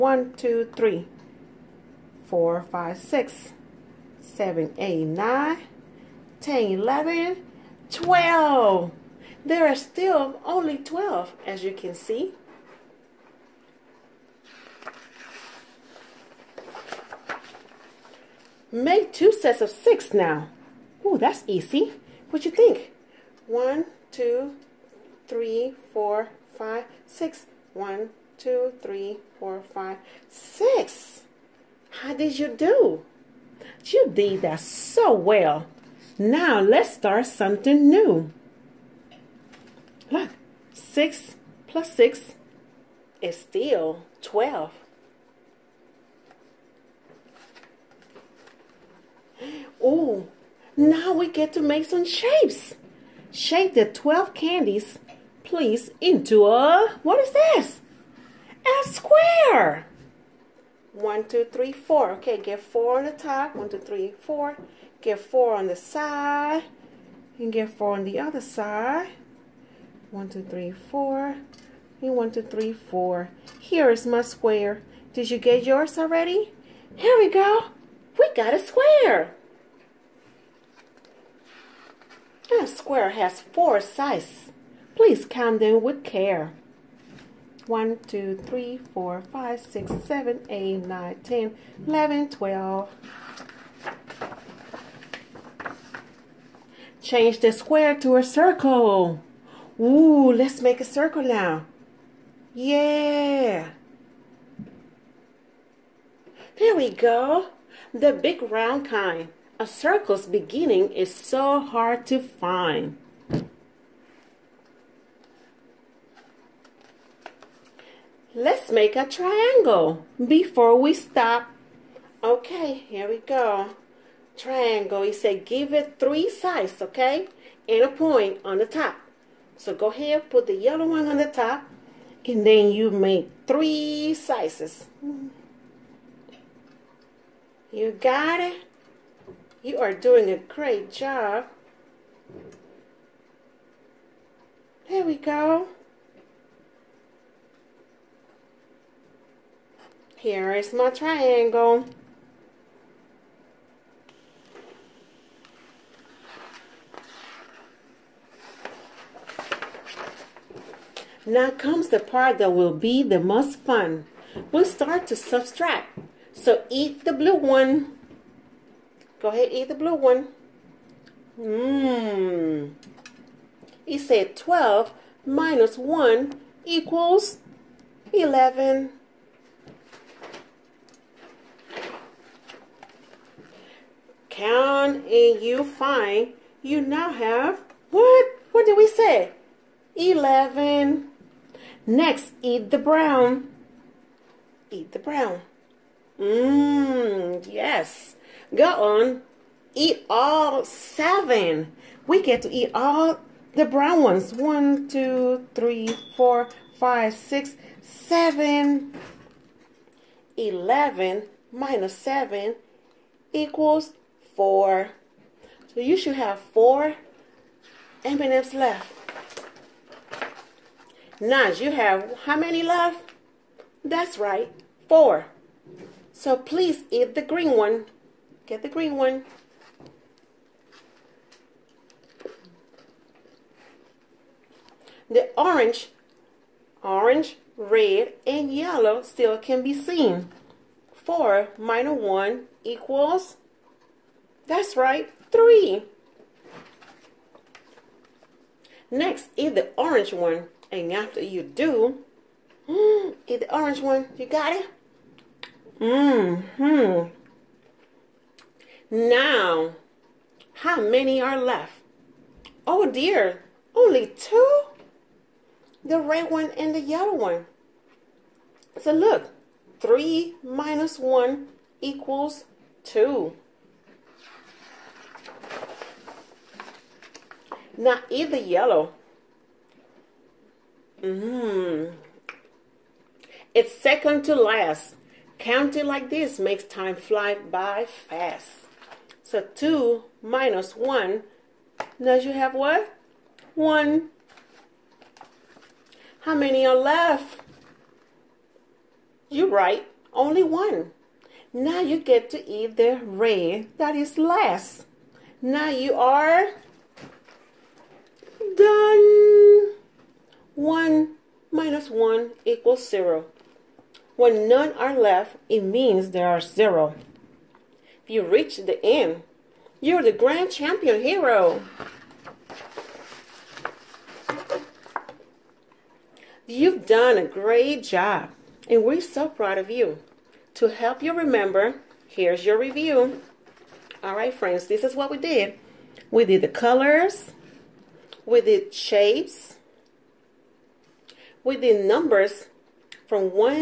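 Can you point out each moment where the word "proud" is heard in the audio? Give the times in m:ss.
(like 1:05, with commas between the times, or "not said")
5:29.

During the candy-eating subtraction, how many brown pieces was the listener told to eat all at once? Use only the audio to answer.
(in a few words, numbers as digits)
7.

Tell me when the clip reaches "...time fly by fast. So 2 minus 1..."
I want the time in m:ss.
4:46.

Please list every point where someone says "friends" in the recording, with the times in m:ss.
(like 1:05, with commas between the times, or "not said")
5:34.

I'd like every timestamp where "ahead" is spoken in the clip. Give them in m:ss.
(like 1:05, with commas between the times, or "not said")
2:09, 2:49.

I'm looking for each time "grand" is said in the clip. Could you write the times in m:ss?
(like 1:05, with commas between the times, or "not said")
5:20.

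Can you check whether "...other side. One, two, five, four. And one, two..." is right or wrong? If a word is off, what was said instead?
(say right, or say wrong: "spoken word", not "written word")
wrong: "three", not "five".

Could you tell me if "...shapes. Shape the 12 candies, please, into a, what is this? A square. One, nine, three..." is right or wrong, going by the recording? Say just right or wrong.
wrong.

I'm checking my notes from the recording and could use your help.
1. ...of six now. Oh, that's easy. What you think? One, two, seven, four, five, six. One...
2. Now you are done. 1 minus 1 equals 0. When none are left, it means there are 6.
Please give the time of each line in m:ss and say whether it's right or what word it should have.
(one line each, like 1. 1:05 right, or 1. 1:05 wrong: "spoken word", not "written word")
1. 0:19 wrong: "three", not "seven"
2. 5:05 wrong: "0", not "6".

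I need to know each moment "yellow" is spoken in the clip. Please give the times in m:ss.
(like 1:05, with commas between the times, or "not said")
2:10, 3:58, 4:26, 4:38.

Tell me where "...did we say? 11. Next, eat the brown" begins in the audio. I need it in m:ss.
3:08.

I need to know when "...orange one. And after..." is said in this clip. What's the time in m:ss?
4:09.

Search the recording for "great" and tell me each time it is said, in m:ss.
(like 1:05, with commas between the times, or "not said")
2:20, 5:27.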